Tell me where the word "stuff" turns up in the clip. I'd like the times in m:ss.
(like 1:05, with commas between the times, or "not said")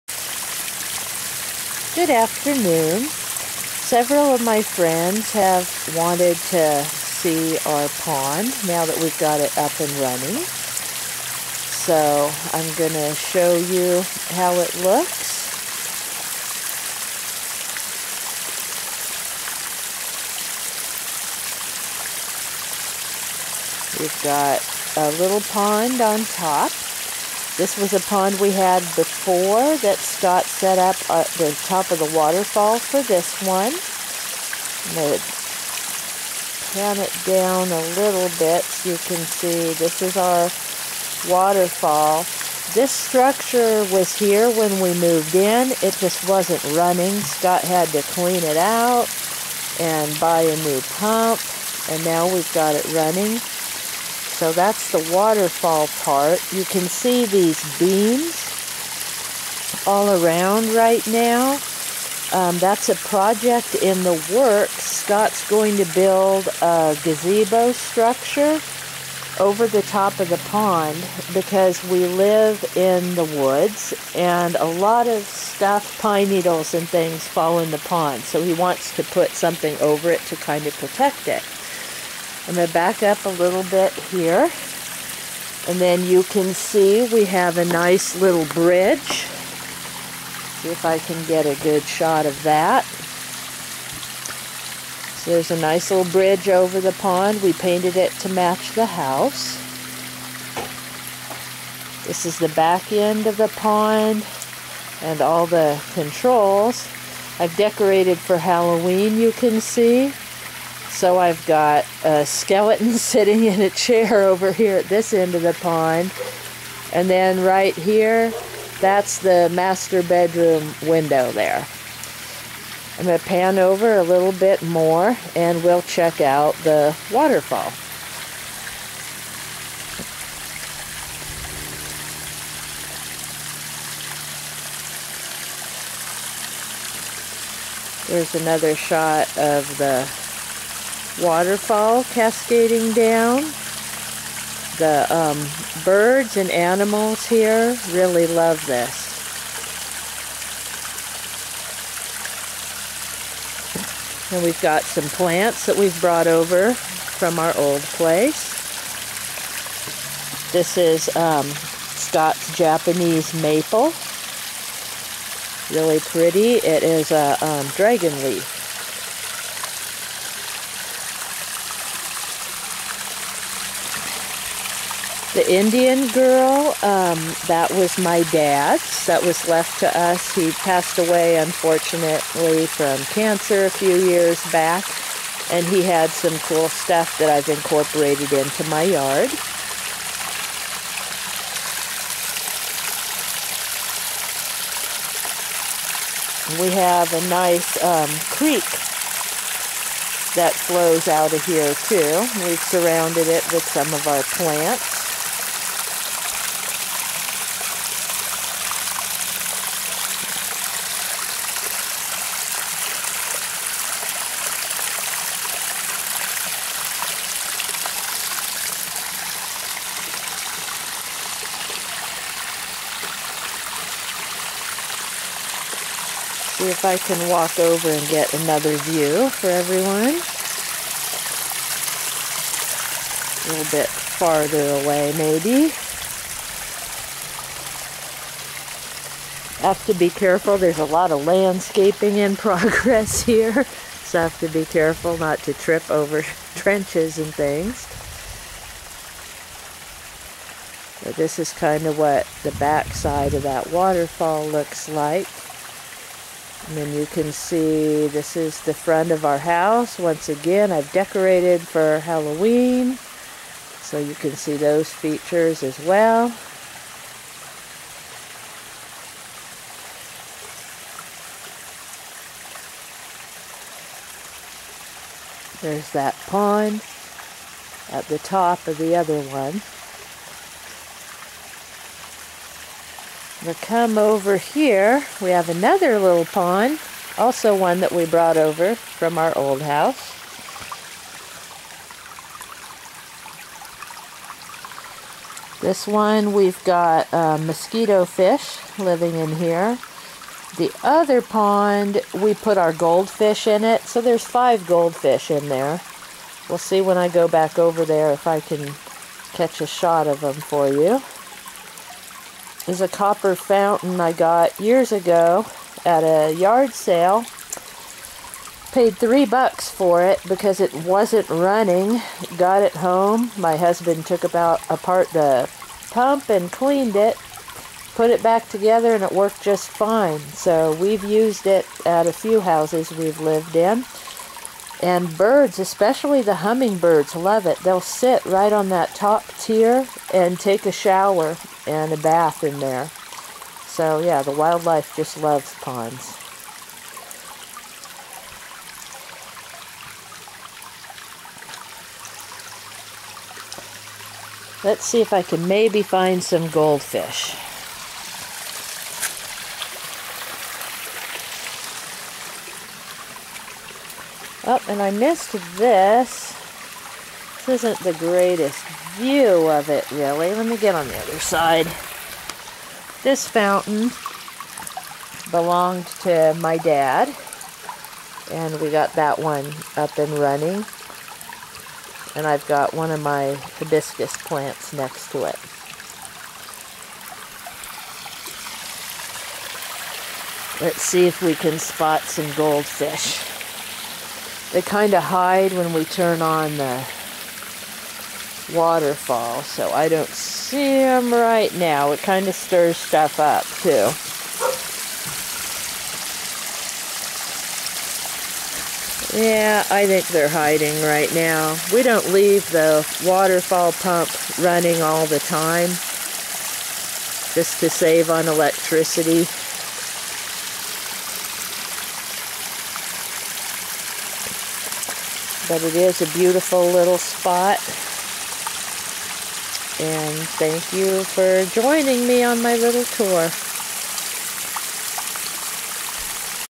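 1:15, 3:06, 6:42.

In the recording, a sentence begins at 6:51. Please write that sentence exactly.
We don't leave the waterfall pump running all the time just to save on electricity.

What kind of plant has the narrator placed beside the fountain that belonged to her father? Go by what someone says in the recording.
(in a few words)
Hibiscus.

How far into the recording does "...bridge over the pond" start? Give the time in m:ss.
1:36.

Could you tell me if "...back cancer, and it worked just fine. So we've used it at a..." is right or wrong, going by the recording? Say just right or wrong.
wrong.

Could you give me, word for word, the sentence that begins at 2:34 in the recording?
And we've got some plants that we've brought over from our old place.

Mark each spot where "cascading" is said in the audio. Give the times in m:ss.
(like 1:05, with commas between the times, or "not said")
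2:22.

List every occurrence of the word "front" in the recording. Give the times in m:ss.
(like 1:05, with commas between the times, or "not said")
4:18.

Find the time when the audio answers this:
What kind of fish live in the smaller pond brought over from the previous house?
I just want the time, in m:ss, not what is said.
4:57.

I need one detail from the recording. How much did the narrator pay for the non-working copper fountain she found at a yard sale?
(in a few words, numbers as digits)
$3.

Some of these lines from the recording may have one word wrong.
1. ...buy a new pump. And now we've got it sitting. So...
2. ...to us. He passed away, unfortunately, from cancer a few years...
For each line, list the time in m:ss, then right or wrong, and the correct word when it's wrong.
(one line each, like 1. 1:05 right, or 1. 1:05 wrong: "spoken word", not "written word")
1. 0:50 wrong: "running", not "sitting"
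2. 2:59 right.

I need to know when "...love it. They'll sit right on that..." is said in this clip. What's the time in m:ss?
5:37.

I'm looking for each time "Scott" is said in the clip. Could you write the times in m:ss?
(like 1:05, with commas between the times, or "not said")
0:29, 0:47, 1:04, 2:41.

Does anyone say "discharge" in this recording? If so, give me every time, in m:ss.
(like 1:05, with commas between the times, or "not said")
not said.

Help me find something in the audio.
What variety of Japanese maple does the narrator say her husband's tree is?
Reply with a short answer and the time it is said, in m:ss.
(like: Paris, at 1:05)
Dragon leaf, at 2:47.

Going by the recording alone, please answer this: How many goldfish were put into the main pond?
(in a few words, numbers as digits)
5.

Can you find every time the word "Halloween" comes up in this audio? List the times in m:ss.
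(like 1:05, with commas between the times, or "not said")
1:48, 4:21.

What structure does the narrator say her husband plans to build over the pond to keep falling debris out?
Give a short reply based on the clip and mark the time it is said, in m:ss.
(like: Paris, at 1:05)
Gazebo, at 1:07.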